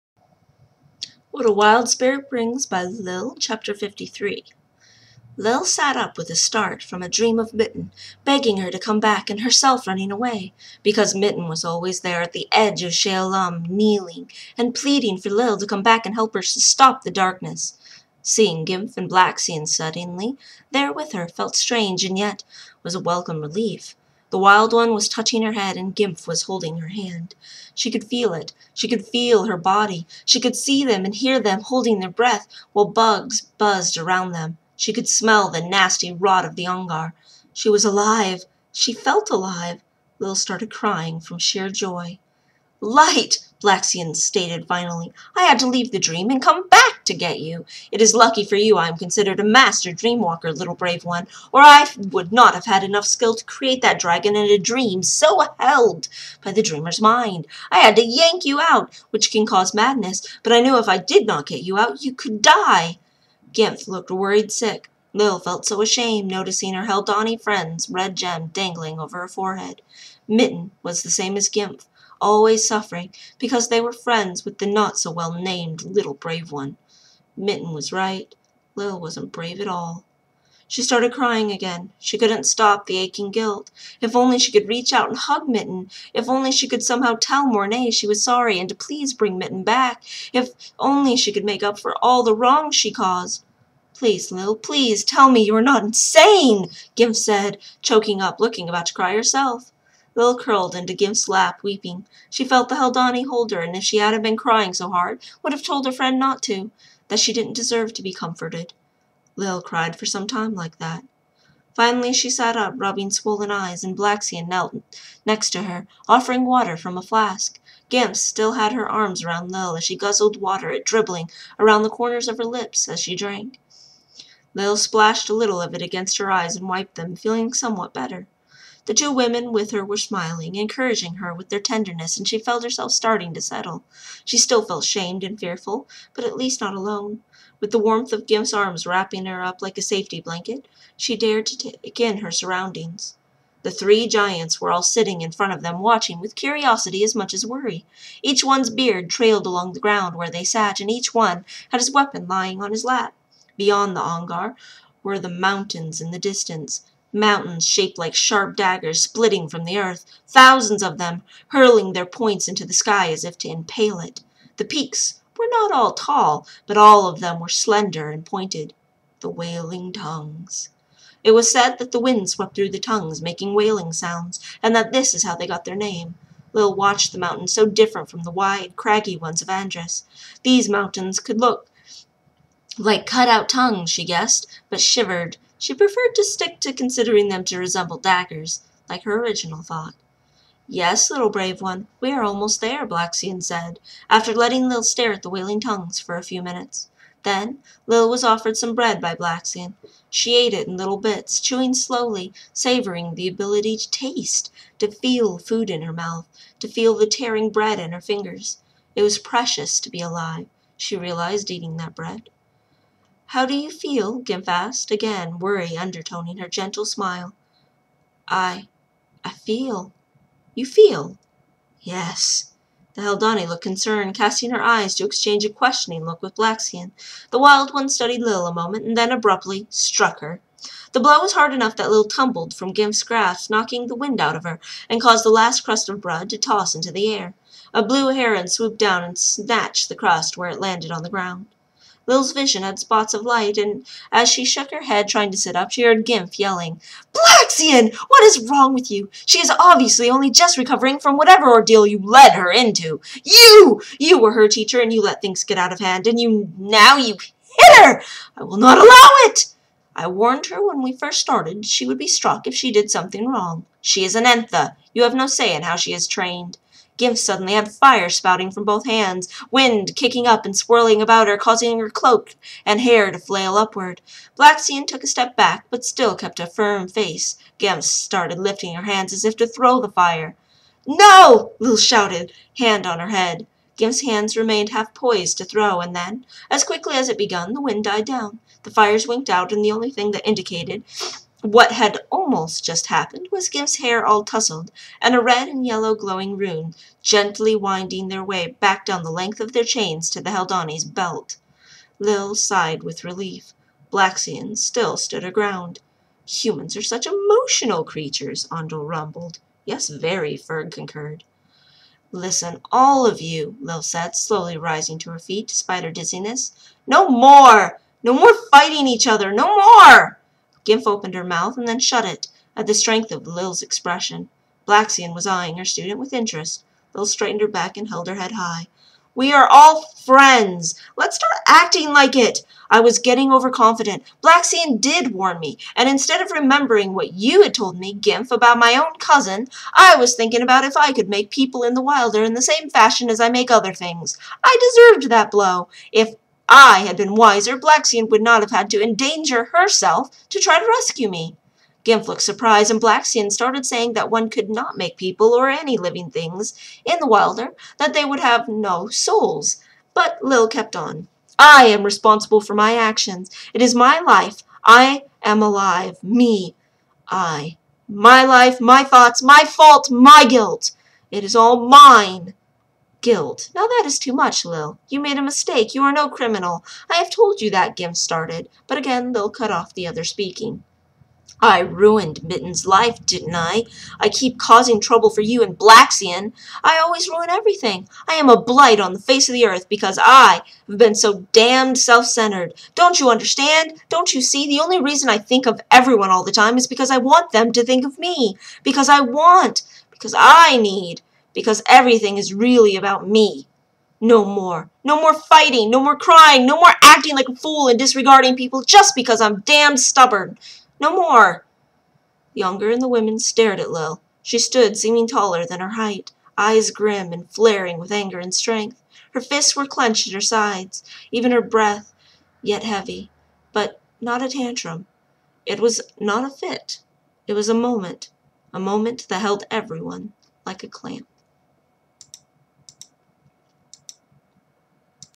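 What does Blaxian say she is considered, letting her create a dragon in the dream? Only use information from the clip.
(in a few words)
master dreamwalker.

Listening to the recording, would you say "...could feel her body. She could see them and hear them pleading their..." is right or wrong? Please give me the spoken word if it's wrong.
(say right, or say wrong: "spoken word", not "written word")
wrong: "holding", not "pleading".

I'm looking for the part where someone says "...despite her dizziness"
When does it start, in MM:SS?
05:15.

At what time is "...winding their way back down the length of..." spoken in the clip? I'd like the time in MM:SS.
04:57.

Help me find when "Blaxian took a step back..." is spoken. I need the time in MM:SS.
04:34.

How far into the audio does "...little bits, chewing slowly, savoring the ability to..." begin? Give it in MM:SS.
03:20.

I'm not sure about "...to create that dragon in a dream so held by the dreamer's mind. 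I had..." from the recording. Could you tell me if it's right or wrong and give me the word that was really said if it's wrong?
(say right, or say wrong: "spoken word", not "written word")
right.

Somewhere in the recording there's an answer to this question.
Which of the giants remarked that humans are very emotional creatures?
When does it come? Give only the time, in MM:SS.
05:08.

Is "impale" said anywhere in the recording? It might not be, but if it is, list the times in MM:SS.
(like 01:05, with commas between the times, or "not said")
02:43.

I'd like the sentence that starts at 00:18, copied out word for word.
Seeing Gimp and Blaxian suddenly there with her felt strange and yet was a welcome relief.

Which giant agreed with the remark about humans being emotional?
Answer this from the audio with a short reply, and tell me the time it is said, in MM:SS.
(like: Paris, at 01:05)
Ferg, at 05:10.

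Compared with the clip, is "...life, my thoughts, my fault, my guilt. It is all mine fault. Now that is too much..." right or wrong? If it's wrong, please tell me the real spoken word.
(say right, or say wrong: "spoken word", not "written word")
wrong: "guilt", not "fault".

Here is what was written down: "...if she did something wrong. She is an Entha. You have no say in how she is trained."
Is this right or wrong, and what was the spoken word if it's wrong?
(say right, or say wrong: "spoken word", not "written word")
right.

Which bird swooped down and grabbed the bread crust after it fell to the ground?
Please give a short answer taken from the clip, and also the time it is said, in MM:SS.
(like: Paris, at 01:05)
blue heron, at 03:57.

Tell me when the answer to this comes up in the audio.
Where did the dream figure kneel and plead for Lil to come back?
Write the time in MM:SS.
00:12.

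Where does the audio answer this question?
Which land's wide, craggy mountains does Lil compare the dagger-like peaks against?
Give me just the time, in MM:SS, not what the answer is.
02:59.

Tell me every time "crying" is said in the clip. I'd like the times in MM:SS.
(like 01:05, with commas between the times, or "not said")
00:40, 01:21, 01:44, 06:45.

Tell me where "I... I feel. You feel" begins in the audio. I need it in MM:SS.
03:38.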